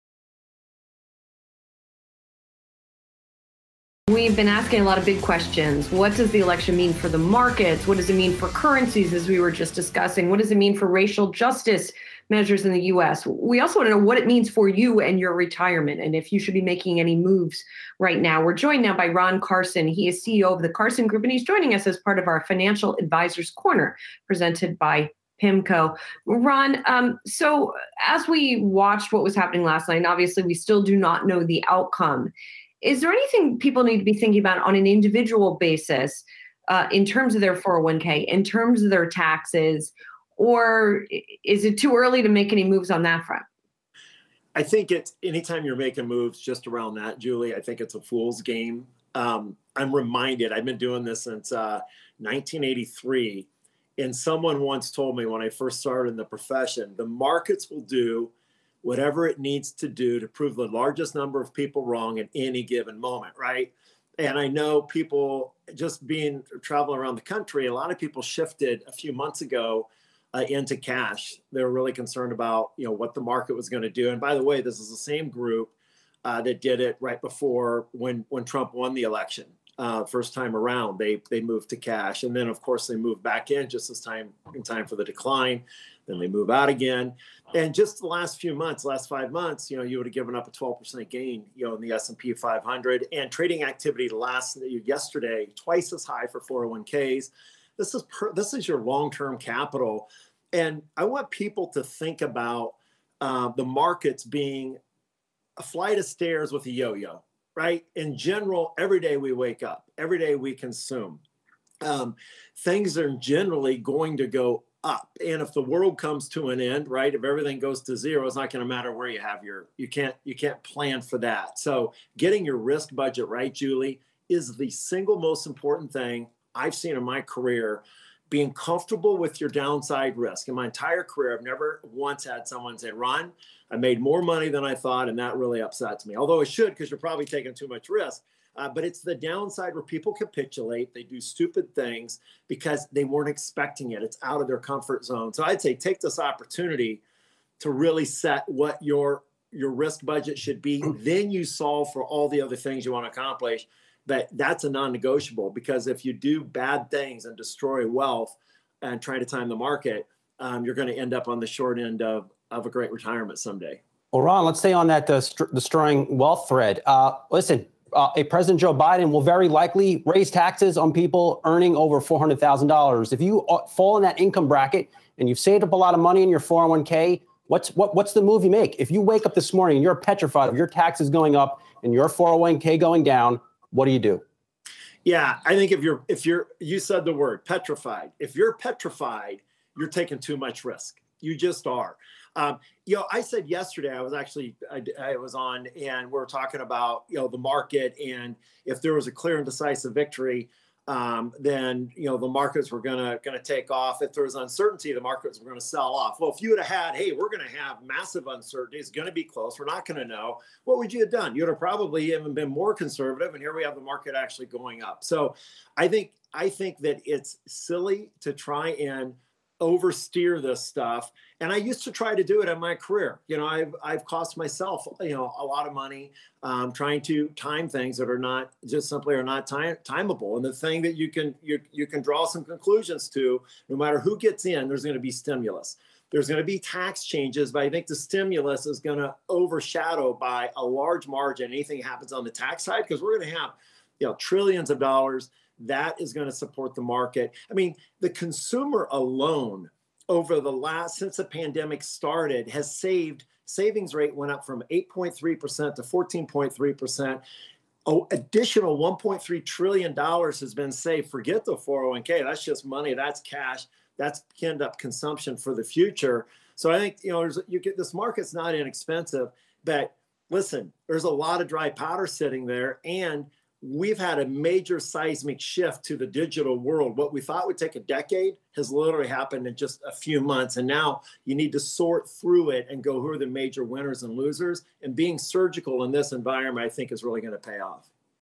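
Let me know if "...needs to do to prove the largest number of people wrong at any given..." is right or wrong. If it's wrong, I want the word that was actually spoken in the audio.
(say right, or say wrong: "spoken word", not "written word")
right.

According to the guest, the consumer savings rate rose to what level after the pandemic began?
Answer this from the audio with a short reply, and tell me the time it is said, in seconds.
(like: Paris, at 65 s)
14.3%, at 255 s.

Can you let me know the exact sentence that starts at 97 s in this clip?
This is per, this is your long-term capital.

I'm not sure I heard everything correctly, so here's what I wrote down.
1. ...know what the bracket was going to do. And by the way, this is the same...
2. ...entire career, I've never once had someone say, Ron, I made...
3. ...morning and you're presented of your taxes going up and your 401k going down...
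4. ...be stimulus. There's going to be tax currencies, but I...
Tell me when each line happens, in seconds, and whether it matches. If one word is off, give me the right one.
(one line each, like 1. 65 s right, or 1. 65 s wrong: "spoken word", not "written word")
1. 72 s wrong: "market", not "bracket"
2. 130 s right
3. 179 s wrong: "petrified", not "presented"
4. 234 s wrong: "changes", not "currencies".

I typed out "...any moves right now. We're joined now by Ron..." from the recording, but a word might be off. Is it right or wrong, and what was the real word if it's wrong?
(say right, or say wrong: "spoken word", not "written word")
right.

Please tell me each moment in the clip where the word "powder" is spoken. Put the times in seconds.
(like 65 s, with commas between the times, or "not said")
271 s.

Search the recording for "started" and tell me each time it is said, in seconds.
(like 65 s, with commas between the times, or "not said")
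55 s, 251 s.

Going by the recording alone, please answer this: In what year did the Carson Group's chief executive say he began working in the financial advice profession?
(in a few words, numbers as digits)
1983.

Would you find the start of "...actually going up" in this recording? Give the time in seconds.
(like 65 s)
214 s.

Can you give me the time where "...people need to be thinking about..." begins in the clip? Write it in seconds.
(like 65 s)
33 s.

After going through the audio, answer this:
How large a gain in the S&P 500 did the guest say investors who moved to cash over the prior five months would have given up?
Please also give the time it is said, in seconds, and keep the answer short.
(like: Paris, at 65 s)
12%, at 90 s.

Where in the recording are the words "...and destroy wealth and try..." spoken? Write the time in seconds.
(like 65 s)
157 s.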